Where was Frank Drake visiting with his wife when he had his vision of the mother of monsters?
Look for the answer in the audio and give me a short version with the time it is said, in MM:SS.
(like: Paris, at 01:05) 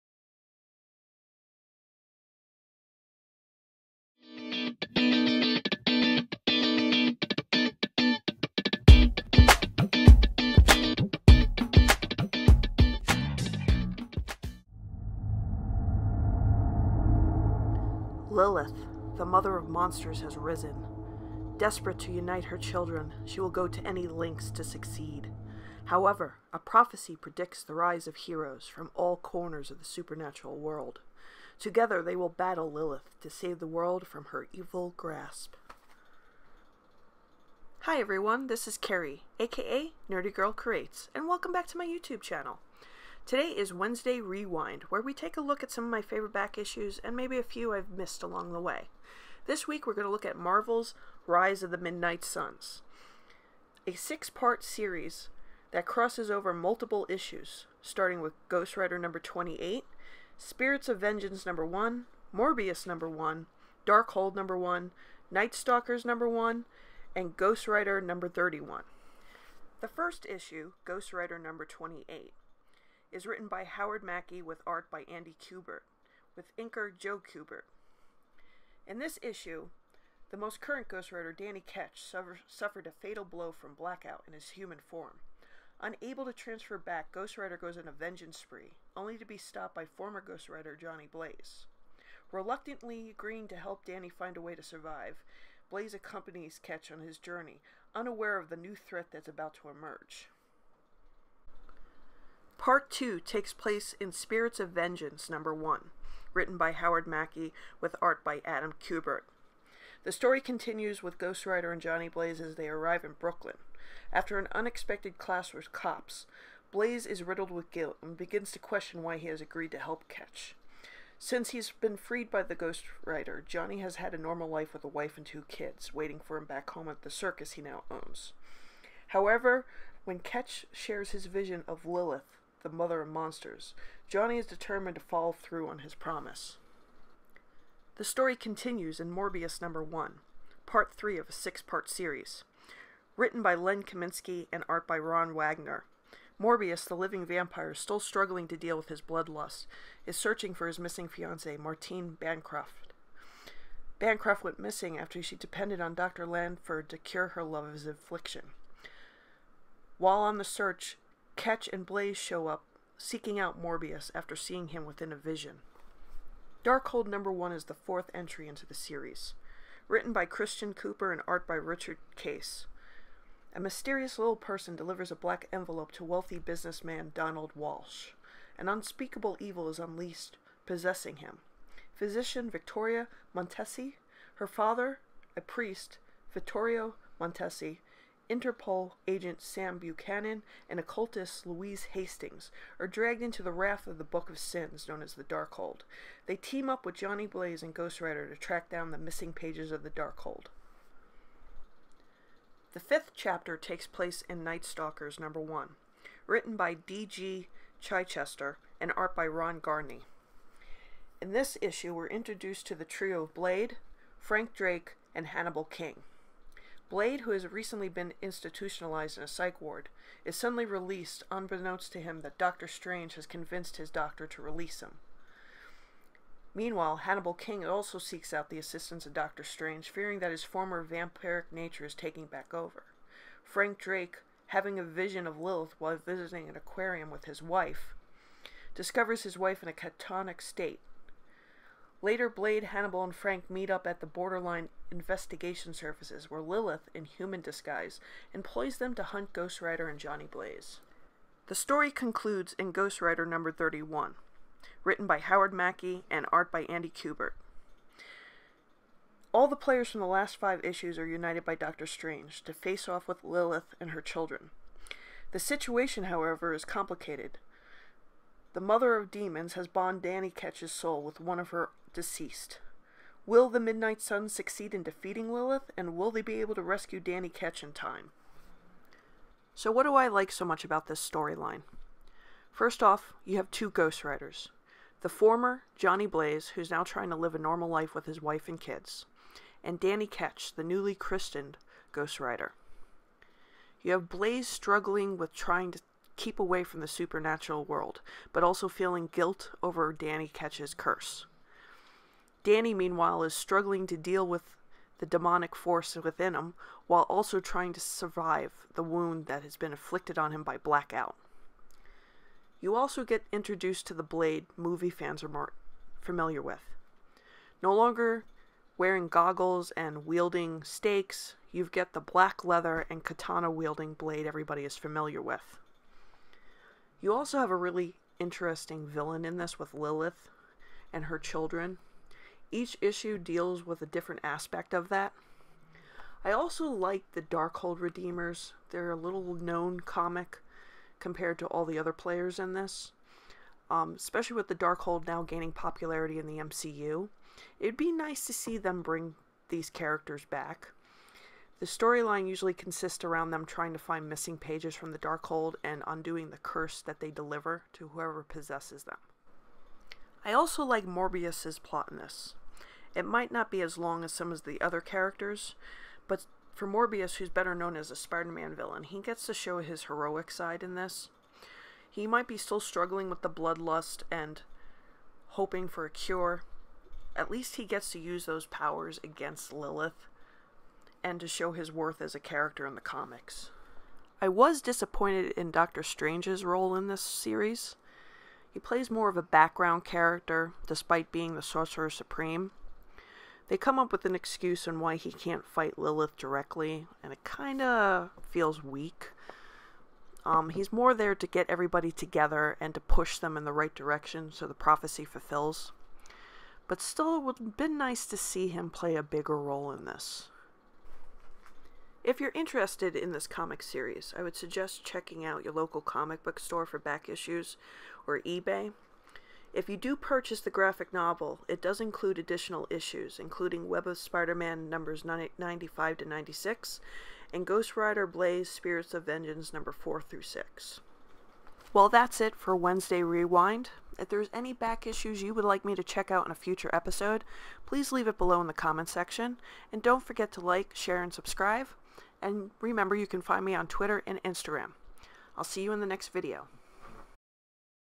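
An aquarium, at 03:56.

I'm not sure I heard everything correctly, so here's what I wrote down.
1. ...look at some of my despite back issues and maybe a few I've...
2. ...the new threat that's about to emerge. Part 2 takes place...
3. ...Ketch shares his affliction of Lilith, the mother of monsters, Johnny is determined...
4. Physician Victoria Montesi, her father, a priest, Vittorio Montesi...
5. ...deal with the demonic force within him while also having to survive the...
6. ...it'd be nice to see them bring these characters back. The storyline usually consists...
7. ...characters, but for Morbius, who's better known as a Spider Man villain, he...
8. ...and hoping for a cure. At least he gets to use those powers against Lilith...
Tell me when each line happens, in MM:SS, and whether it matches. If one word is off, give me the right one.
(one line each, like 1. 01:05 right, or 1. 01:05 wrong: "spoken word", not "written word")
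1. 00:45 wrong: "favorite", not "despite"
2. 01:38 right
3. 02:10 wrong: "vision", not "affliction"
4. 03:01 right
5. 05:03 wrong: "trying", not "having"
6. 05:47 right
7. 06:04 right
8. 06:14 right.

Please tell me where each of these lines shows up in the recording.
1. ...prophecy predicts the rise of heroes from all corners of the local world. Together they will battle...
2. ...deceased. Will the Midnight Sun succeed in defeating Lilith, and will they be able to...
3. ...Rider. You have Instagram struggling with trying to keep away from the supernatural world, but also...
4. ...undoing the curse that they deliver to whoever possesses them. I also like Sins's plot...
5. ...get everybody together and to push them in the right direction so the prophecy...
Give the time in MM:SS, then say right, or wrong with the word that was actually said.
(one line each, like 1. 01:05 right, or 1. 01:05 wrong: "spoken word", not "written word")
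1. 00:26 wrong: "supernatural", not "local"
2. 04:31 right
3. 04:52 wrong: "Blaze", not "Instagram"
4. 05:55 wrong: "Morbius", not "Sins"
5. 06:41 right.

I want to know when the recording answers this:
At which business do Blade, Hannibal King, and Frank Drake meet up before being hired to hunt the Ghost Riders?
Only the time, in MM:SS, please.
04:04.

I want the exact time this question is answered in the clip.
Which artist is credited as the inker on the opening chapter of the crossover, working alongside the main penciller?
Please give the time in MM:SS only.
01:16.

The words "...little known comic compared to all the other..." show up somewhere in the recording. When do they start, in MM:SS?
05:38.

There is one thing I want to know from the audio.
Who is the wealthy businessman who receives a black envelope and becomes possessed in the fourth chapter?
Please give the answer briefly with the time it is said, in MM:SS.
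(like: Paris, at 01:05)
Donald Walsh, at 02:57.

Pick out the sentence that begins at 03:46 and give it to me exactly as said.
Meanwhile, Hannibal King also seeks out the assistance of Doctor Strange, fearing that his former vampiric nature is taking back over.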